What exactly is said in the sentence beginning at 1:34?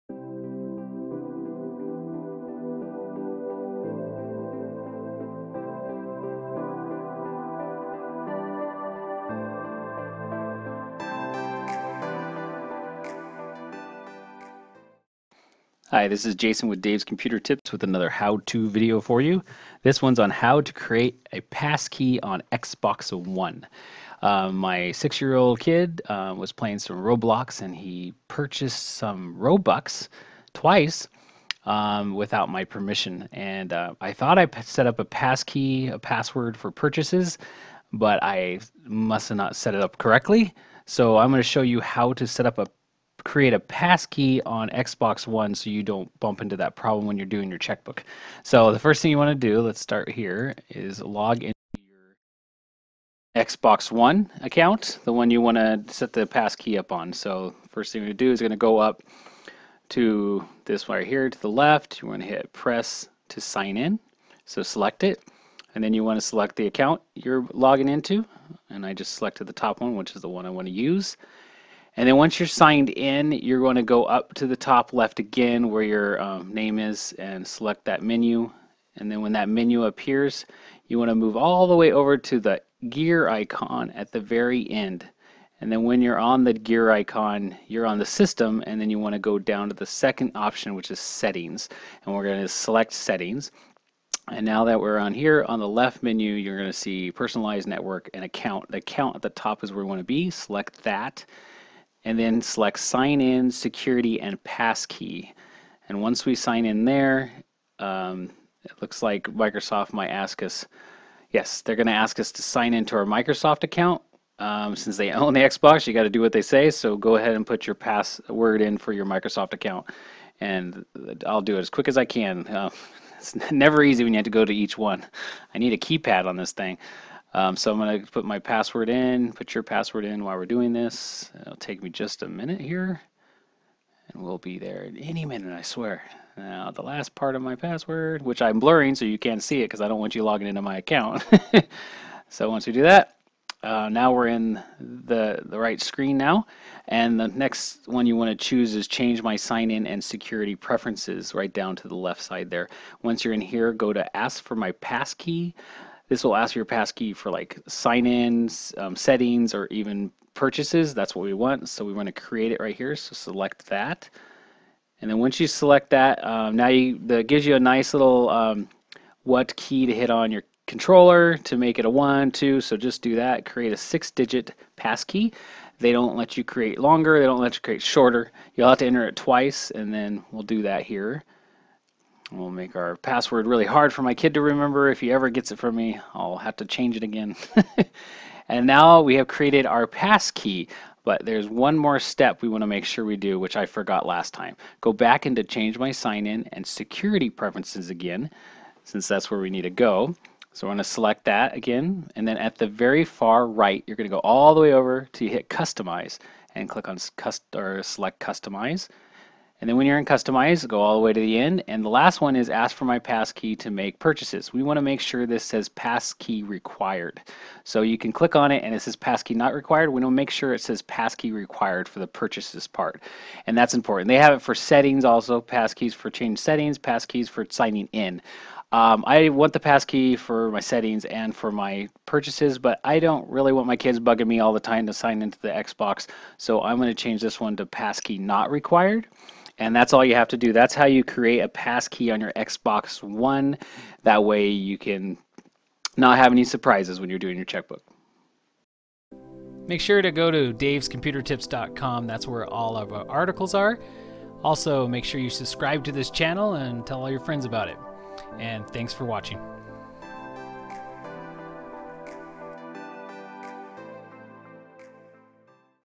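And now that we're on here, on the left menu, you're going to see personalized network and account.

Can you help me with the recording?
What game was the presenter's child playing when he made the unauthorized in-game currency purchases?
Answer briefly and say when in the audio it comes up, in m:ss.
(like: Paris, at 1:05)
Roblox, at 0:26.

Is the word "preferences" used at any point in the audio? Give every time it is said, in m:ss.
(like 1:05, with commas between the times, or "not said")
2:30, 3:17.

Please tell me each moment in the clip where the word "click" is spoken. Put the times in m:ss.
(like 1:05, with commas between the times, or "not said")
3:26, 3:38.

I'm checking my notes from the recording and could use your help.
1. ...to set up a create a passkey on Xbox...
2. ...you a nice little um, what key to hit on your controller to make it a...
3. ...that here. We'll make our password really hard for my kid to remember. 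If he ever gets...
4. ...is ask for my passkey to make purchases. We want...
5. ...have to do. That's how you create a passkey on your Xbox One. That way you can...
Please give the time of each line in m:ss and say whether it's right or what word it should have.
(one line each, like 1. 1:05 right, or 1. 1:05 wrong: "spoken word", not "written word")
1. 0:42 right
2. 2:47 right
3. 3:00 right
4. 3:32 right
5. 4:00 right.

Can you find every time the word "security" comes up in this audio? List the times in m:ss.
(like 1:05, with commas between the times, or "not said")
1:43, 2:30, 3:16.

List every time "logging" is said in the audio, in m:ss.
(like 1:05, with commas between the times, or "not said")
1:07, 2:20.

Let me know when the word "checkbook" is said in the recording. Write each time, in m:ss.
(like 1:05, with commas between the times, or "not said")
0:47, 4:07.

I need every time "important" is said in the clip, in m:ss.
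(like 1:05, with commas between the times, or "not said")
3:43.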